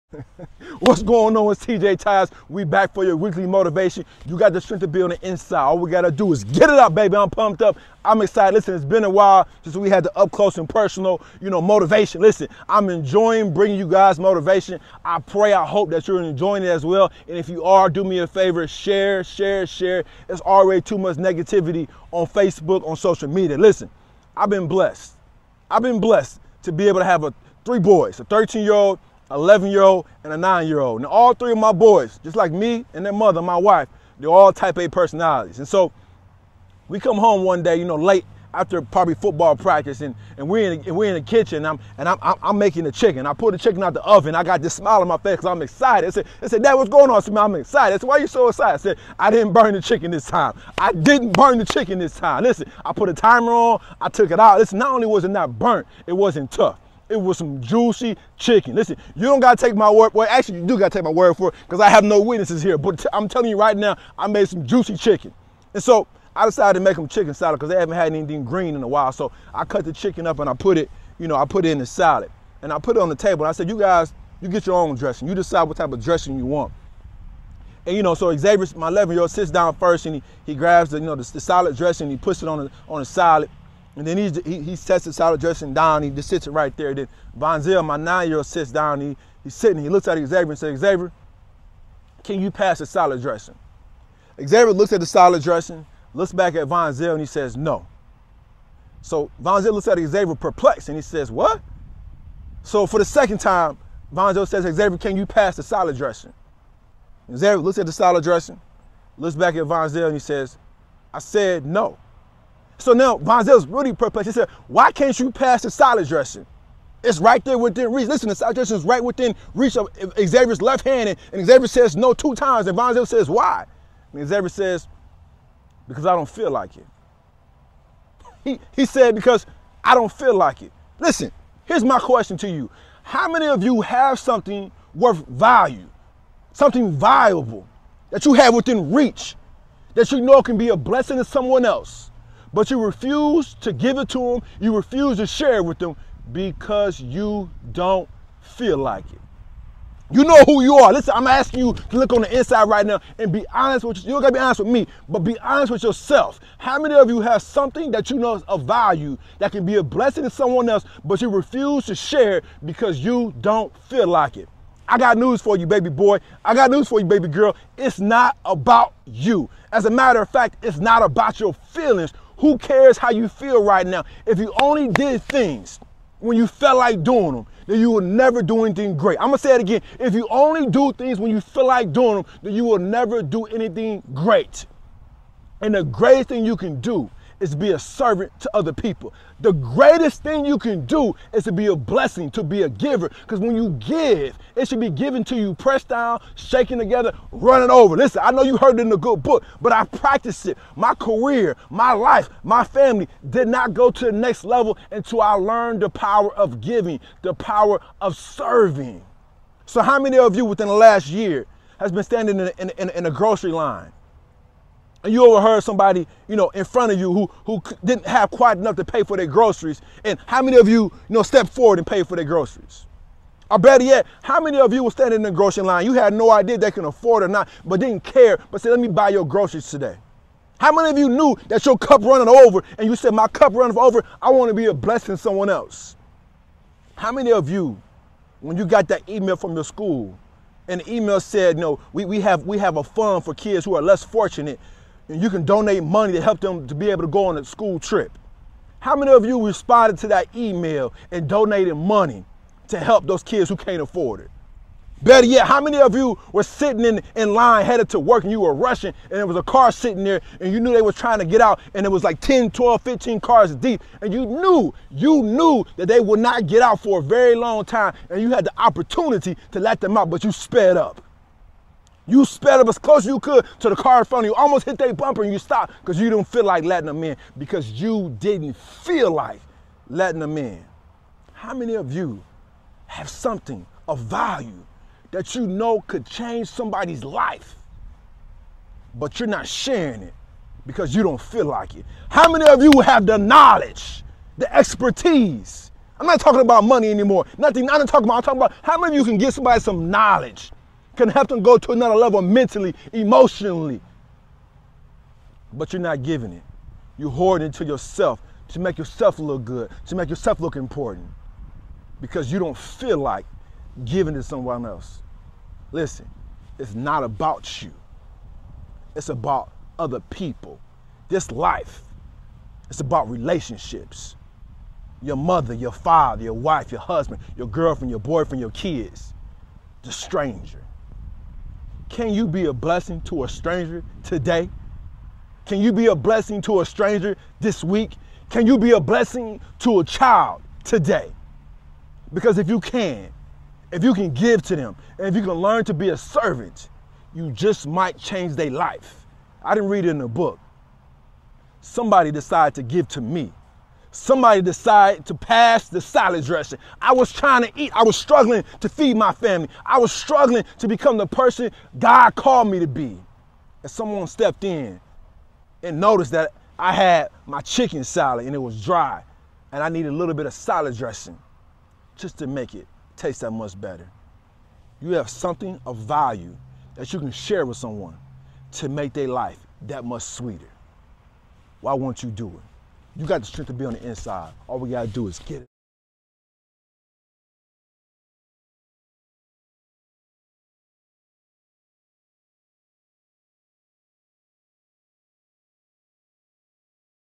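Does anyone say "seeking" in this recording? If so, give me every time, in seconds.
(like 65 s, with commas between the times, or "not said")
not said.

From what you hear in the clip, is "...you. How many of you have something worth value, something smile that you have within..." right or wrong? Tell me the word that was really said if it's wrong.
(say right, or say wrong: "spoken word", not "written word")
wrong: "valuable", not "smile".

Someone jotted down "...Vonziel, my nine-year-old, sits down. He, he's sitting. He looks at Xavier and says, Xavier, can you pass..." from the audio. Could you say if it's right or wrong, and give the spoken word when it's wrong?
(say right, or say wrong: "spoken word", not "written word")
right.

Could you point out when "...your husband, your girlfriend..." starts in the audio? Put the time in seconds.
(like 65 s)
326 s.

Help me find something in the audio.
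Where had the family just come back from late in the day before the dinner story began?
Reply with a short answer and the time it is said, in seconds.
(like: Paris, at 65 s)
football practice, at 39 s.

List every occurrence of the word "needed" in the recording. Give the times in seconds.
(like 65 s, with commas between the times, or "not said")
369 s.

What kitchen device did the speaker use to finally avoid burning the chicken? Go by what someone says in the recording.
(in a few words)
timer.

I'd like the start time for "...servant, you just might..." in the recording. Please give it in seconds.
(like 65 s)
345 s.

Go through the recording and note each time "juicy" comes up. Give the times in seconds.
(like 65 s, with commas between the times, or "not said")
57 s, 64 s.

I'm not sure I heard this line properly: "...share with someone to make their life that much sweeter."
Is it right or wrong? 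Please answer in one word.
right.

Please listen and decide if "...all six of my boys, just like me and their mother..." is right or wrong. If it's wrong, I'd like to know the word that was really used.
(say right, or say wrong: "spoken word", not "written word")
wrong: "three", not "six".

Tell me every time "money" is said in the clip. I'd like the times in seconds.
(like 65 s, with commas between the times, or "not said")
245 s, 251 s, 296 s.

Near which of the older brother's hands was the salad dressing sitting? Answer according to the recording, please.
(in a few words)
left hand.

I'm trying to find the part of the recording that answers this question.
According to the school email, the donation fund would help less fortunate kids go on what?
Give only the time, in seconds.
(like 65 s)
247 s.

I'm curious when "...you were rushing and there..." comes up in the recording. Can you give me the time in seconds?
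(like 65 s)
258 s.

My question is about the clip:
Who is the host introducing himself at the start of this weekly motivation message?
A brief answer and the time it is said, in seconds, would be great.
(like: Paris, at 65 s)
TJ Tyus, at 1 s.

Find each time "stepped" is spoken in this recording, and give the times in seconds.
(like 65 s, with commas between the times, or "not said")
221 s, 364 s.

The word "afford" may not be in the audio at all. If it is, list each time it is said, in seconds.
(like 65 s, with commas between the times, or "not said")
226 s, 253 s.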